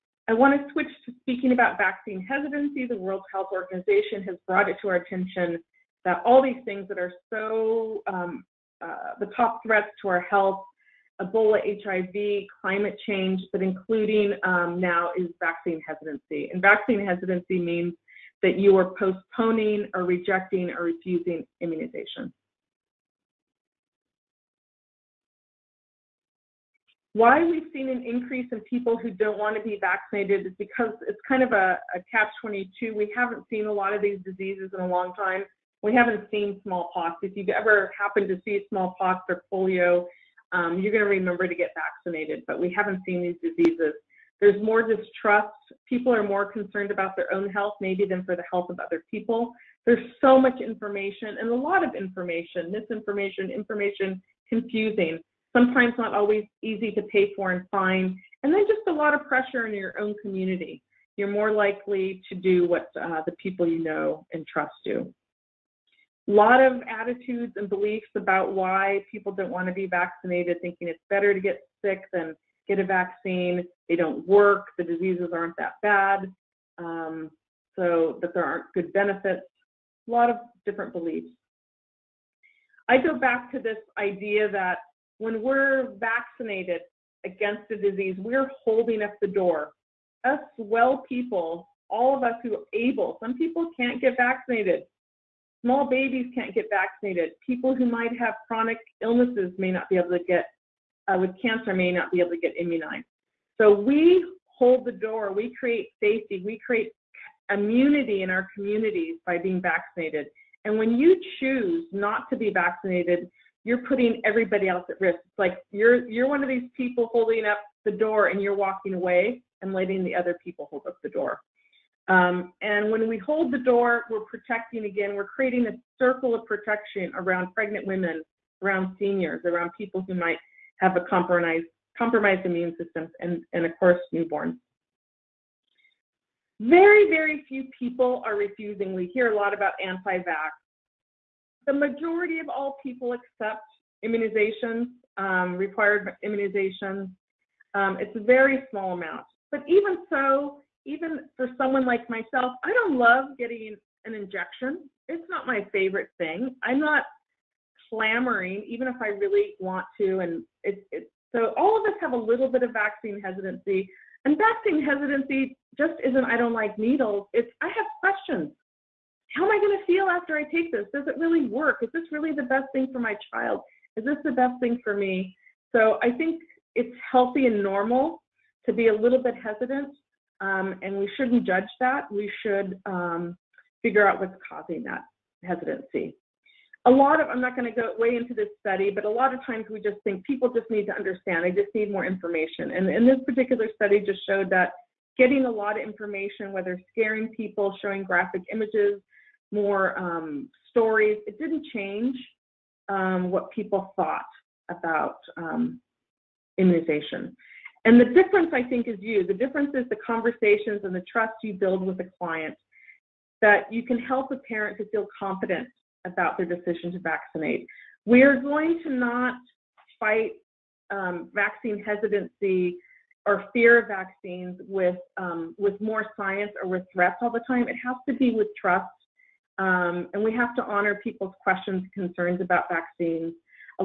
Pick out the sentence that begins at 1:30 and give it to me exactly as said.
Us well people, all of us who are able, some people can't get vaccinated.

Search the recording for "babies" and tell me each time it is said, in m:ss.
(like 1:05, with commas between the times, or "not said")
1:35.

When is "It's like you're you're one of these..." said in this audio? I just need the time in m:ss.
1:55.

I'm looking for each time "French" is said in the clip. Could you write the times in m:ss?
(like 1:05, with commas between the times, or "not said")
not said.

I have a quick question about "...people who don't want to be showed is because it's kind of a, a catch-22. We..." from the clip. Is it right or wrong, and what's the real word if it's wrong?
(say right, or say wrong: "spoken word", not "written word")
wrong: "vaccinated", not "showed".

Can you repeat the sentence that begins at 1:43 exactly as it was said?
So we hold the door, we create safety, we create immunity in our communities by being vaccinated.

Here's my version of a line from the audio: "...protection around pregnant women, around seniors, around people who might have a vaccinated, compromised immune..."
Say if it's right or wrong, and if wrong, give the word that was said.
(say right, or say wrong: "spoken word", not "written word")
wrong: "compromised", not "vaccinated".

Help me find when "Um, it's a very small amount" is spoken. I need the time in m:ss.
2:27.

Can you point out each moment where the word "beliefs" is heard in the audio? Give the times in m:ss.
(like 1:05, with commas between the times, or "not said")
1:07, 1:20.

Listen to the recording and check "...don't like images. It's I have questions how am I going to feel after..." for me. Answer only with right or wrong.
wrong.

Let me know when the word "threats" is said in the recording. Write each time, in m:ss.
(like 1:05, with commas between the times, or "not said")
0:09, 3:46.